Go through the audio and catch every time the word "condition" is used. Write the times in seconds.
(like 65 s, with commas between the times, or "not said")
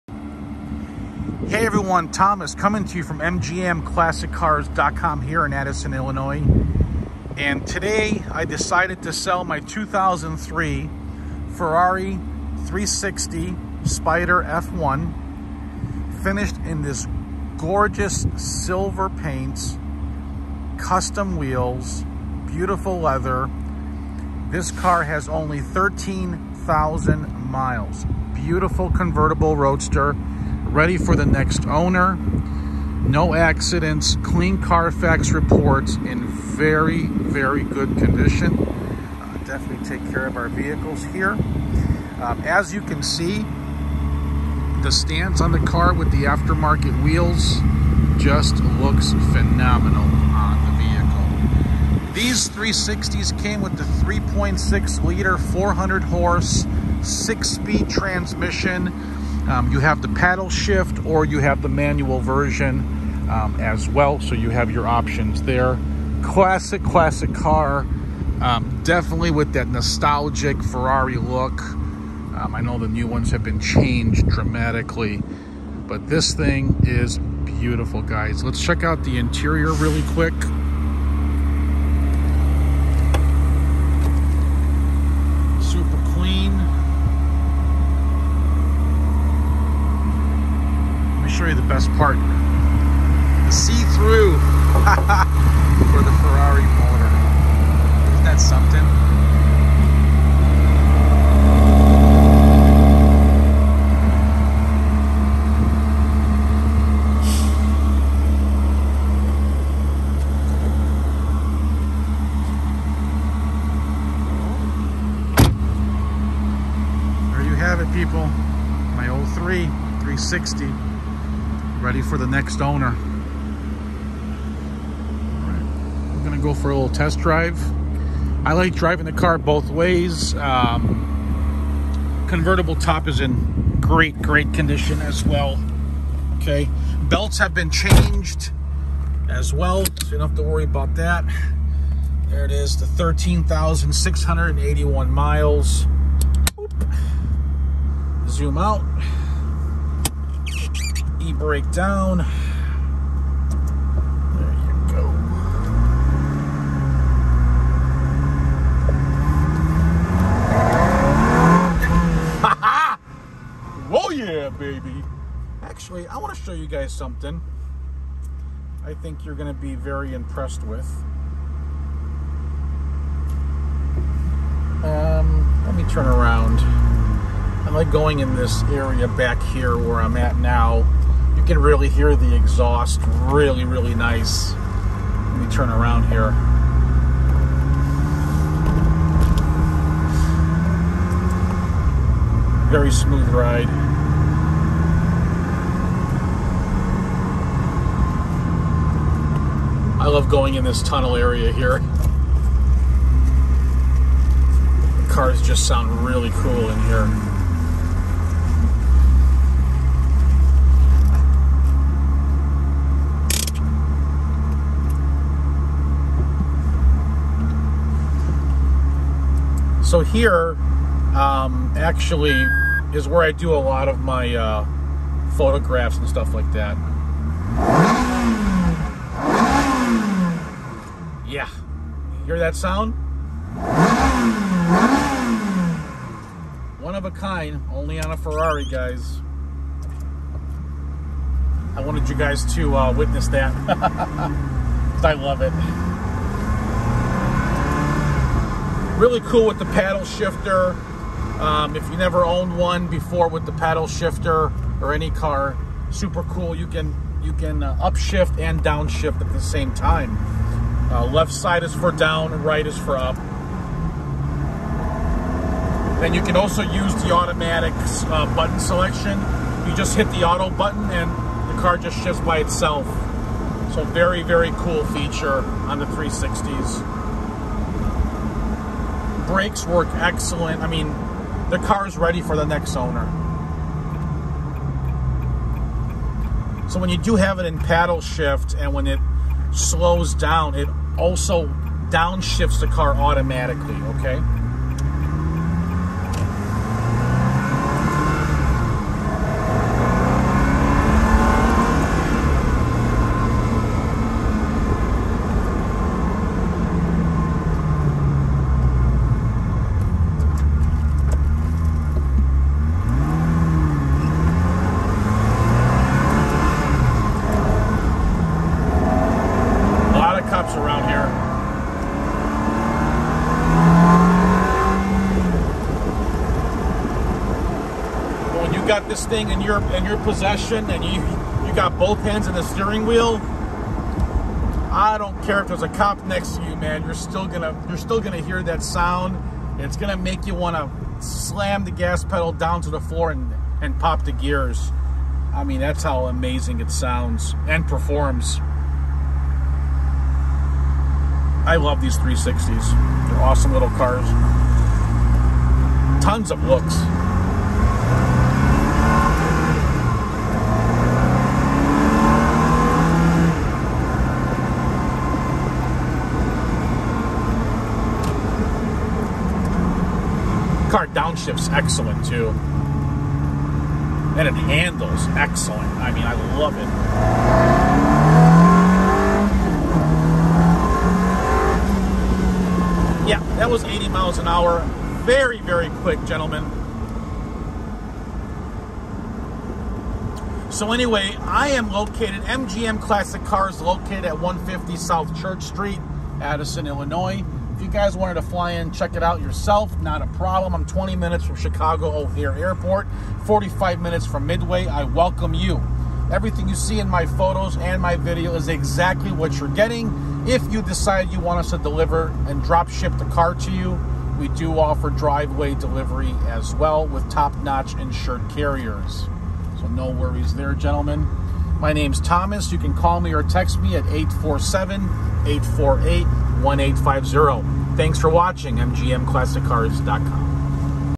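37 s, 134 s.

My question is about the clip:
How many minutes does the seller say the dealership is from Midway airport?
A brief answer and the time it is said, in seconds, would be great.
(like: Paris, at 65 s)
45 minutes, at 403 s.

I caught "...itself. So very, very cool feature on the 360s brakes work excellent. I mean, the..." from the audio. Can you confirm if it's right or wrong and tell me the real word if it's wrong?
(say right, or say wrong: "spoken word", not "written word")
right.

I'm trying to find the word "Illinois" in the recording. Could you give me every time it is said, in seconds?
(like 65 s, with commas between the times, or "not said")
5 s, 396 s.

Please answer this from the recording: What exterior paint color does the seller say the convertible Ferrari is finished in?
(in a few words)
Silver.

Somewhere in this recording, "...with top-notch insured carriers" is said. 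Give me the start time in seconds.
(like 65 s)
416 s.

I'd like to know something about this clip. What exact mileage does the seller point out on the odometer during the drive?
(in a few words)
13,681.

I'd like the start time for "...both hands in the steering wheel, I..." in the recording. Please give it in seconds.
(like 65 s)
331 s.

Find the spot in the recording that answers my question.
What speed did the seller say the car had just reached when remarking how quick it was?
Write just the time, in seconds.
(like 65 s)
383 s.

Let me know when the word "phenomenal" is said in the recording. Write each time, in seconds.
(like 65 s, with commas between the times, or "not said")
49 s.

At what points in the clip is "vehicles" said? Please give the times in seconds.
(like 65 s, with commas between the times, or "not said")
40 s, 52 s.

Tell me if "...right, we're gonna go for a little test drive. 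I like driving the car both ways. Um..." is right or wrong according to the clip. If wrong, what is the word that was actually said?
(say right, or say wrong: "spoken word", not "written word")
right.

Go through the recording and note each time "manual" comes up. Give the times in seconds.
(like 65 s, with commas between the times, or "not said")
61 s.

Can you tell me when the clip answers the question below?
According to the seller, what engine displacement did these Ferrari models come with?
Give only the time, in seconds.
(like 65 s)
53 s.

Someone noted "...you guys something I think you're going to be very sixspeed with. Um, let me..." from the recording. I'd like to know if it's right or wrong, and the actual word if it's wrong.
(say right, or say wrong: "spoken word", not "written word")
wrong: "impressed", not "sixspeed".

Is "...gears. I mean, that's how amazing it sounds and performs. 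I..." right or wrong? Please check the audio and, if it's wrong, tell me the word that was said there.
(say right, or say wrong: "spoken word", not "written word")
right.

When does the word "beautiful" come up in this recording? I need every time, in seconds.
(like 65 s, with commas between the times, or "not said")
22 s, 28 s, 77 s.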